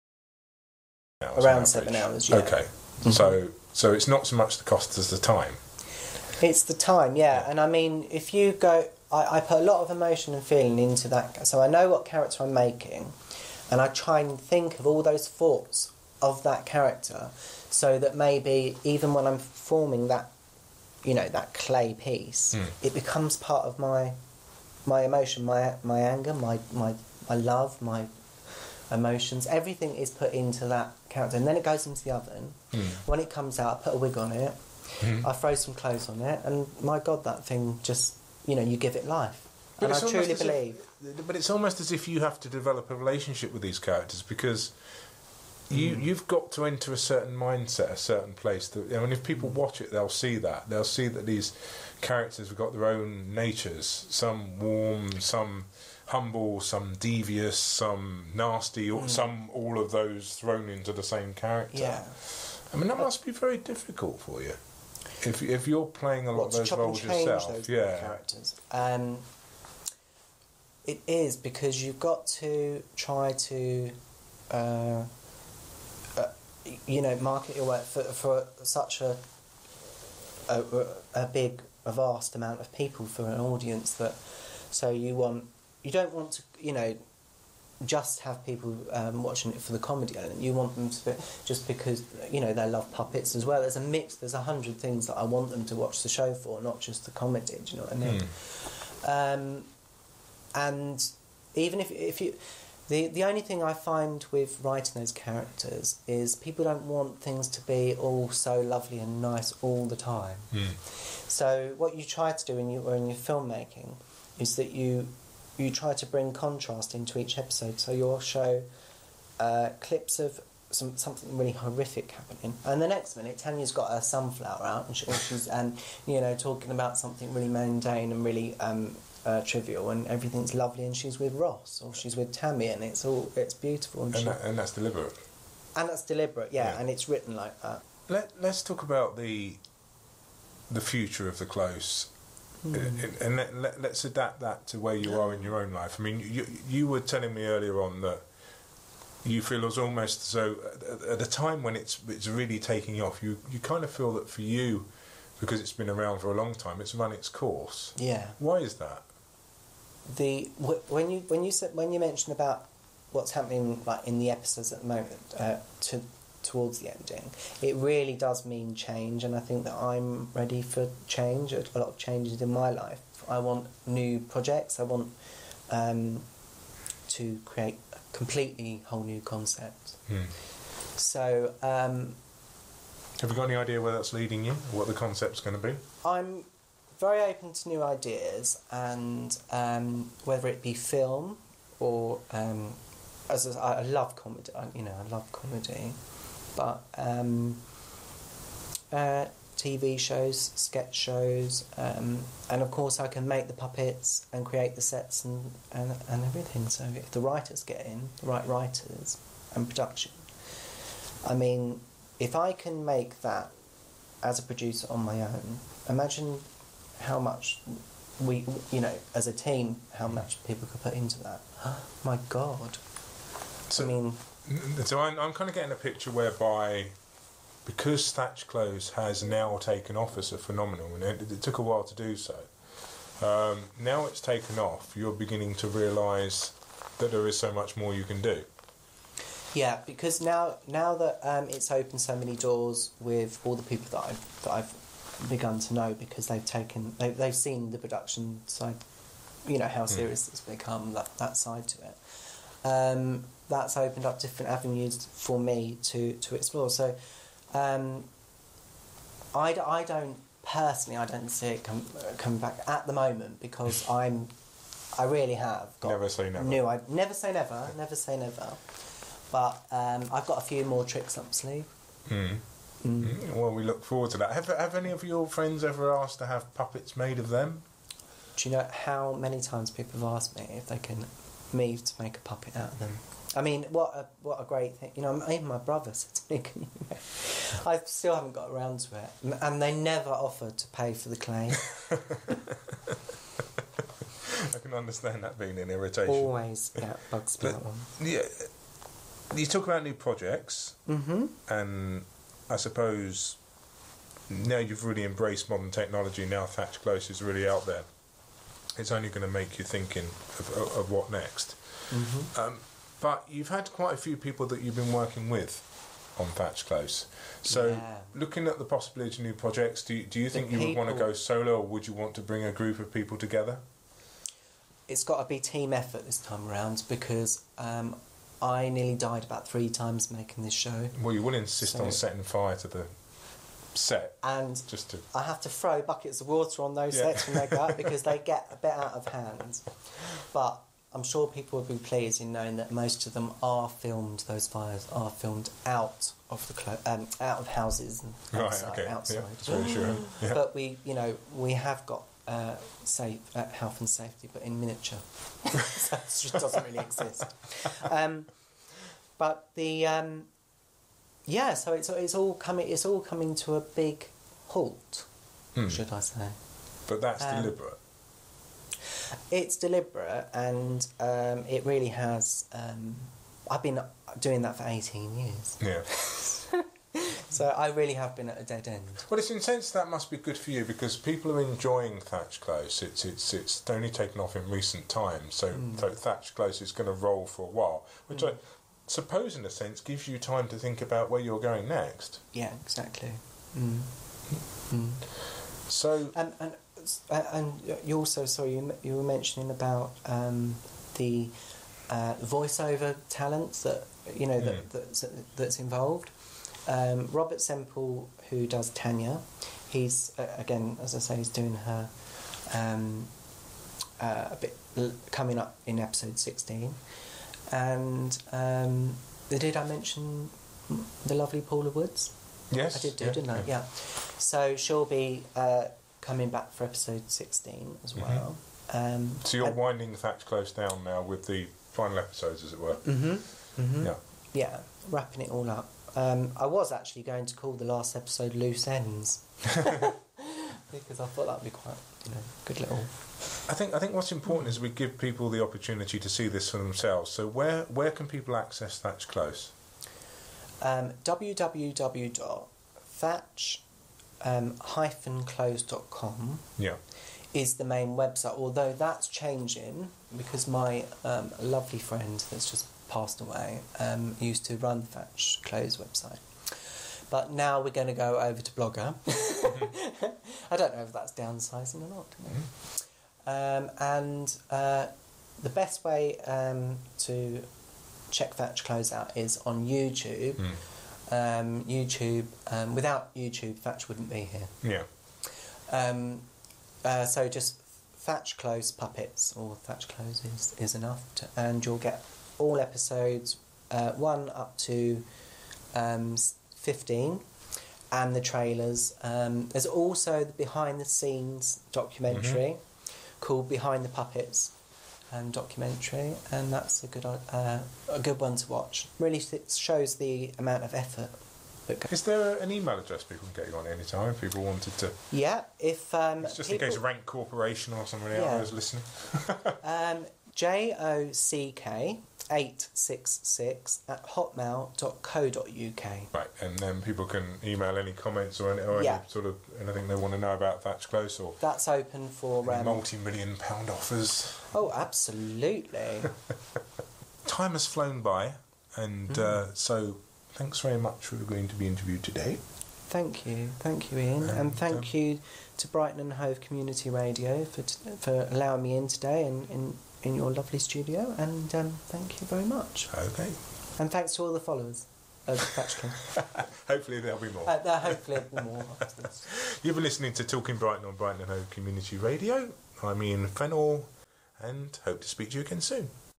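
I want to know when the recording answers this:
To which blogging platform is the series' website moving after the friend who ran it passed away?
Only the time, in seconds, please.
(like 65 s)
468 s.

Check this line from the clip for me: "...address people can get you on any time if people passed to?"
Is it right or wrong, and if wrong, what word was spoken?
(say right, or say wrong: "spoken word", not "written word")
wrong: "wanted", not "passed".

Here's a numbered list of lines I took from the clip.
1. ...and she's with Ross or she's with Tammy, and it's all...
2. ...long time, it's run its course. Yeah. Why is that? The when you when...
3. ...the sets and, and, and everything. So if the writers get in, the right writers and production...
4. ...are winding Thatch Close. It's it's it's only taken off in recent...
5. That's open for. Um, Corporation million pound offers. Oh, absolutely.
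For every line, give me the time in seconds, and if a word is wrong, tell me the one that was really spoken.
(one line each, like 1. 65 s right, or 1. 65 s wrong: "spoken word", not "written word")
1. 130 s right
2. 156 s right
3. 204 s right
4. 381 s wrong: "enjoying", not "winding"
5. 531 s wrong: "Multi", not "Corporation".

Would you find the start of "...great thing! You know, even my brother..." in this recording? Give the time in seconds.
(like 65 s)
284 s.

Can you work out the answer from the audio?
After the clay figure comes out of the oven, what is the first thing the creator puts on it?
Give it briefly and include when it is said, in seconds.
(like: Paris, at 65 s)
A wig, at 33 s.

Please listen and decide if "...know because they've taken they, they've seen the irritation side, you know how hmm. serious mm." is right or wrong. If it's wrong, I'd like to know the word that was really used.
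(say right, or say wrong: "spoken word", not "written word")
wrong: "production", not "irritation".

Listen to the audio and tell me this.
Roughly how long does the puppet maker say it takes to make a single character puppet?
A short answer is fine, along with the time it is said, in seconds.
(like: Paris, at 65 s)
7 hours, at 1 s.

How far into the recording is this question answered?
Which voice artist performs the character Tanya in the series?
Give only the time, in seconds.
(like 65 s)
407 s.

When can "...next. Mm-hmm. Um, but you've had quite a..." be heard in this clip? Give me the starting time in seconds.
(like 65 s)
311 s.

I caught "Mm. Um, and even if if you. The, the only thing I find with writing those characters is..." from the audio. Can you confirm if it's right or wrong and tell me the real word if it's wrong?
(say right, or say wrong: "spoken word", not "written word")
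right.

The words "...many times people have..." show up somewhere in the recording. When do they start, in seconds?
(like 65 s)
279 s.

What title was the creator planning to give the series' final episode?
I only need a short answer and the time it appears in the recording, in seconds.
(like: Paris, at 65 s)
Loose Ends, at 438 s.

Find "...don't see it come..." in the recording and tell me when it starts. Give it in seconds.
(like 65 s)
261 s.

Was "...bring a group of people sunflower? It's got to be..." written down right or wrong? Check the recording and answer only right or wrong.
wrong.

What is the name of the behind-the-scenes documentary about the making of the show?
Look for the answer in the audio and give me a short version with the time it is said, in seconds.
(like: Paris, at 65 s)
Behind the Puppets, at 503 s.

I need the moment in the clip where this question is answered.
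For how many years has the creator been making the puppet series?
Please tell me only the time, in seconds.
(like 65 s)
374 s.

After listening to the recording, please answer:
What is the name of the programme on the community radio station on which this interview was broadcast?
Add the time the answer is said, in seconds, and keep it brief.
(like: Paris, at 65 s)
Talking Brighton, at 560 s.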